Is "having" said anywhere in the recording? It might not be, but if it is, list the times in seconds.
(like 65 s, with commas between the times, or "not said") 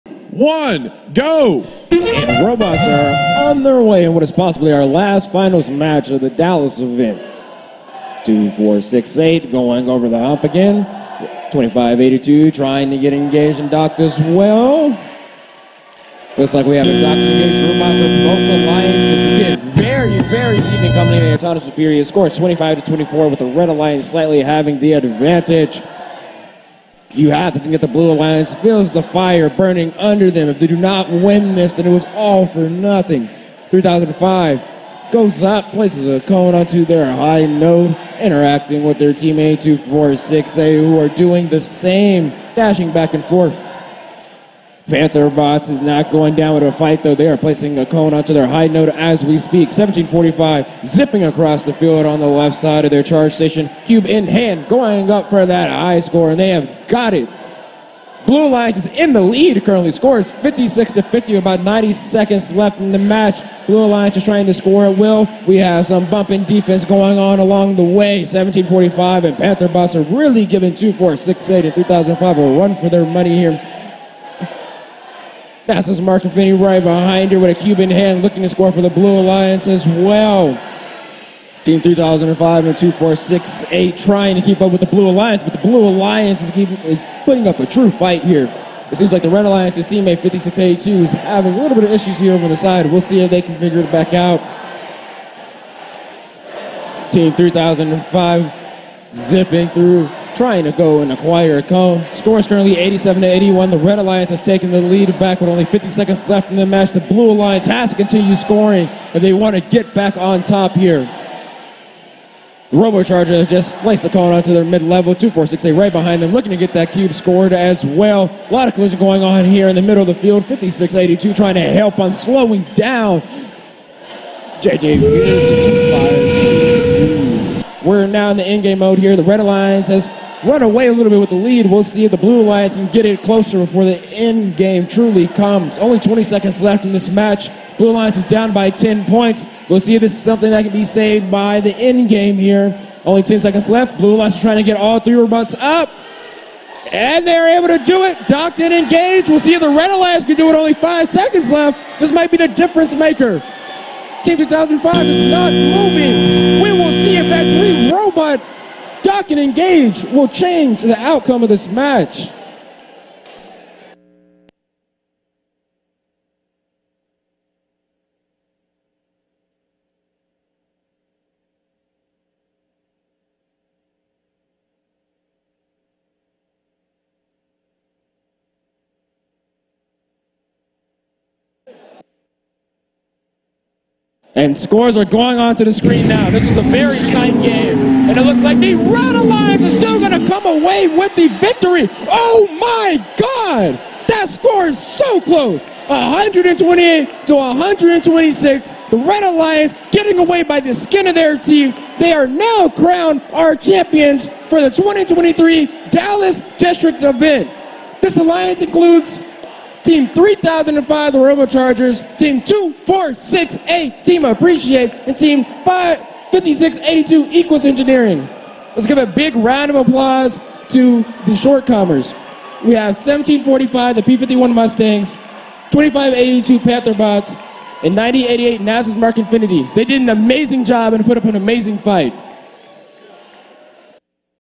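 24 s, 91 s.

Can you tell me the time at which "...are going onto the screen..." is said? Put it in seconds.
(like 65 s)
184 s.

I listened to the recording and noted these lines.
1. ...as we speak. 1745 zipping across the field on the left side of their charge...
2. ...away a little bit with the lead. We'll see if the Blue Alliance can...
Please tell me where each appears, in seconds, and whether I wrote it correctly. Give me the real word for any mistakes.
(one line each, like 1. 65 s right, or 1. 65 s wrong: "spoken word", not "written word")
1. 48 s right
2. 130 s right.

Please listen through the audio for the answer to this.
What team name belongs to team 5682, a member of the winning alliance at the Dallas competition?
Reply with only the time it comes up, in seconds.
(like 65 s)
217 s.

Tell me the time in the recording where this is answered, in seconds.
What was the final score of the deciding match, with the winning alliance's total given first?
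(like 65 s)
195 s.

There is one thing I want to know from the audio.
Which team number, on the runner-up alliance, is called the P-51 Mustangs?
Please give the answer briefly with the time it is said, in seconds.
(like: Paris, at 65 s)
1745, at 222 s.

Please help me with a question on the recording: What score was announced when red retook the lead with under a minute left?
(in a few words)
87 to 81.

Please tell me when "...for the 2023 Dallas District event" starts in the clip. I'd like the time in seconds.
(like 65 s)
204 s.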